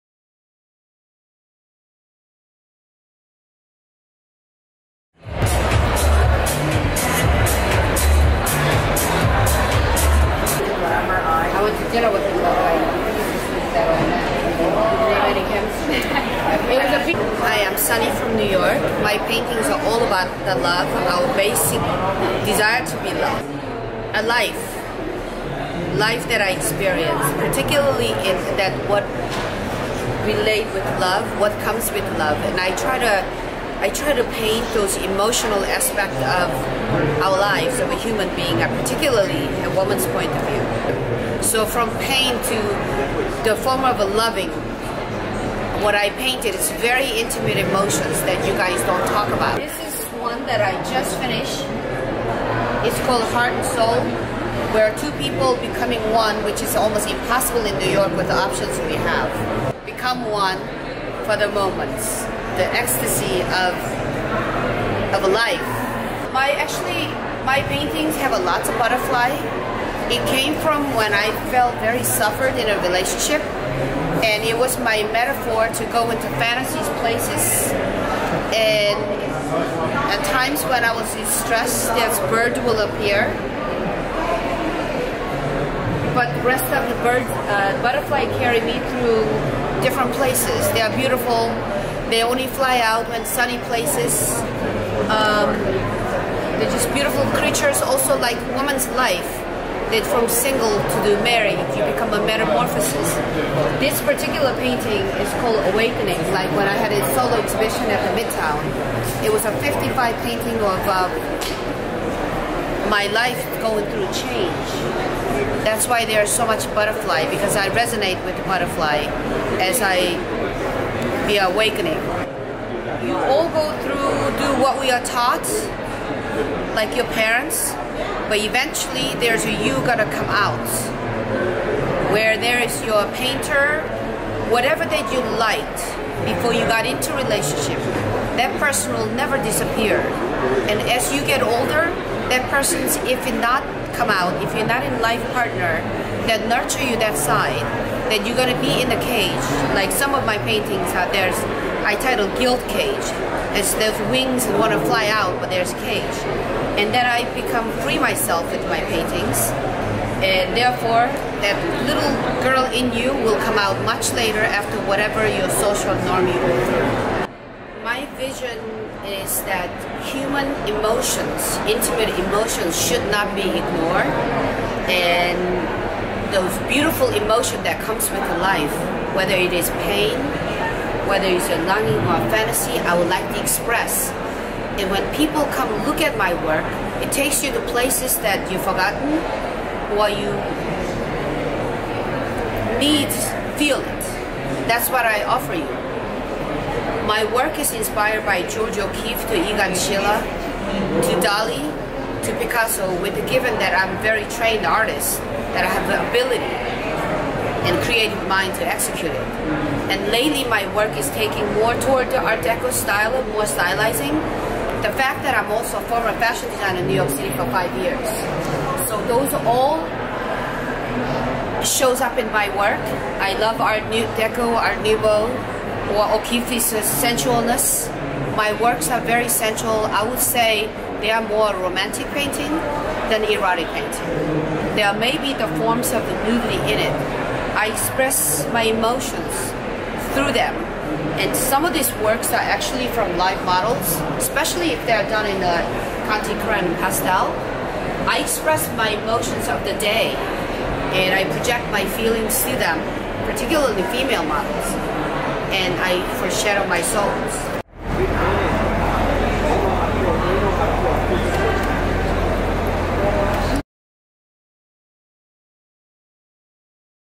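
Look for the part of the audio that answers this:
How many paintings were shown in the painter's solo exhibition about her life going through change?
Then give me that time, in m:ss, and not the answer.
1:49.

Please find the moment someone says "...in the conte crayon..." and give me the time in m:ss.
4:05.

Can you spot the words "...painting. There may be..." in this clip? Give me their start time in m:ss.
3:53.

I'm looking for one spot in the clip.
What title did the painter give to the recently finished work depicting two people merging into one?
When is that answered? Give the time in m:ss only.
0:53.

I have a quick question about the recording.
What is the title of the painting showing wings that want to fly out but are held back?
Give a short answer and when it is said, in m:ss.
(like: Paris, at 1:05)
Guilt Cage, at 2:32.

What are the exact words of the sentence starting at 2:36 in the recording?
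And then I become free myself with my paintings.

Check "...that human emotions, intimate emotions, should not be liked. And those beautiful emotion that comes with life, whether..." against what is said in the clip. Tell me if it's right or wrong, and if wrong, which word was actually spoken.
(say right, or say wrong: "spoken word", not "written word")
wrong: "ignored", not "liked".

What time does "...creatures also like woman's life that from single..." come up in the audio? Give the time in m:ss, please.
1:37.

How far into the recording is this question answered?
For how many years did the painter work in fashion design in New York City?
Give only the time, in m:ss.
3:37.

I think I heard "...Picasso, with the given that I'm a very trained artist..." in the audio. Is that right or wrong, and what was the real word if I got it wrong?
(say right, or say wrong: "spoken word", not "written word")
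right.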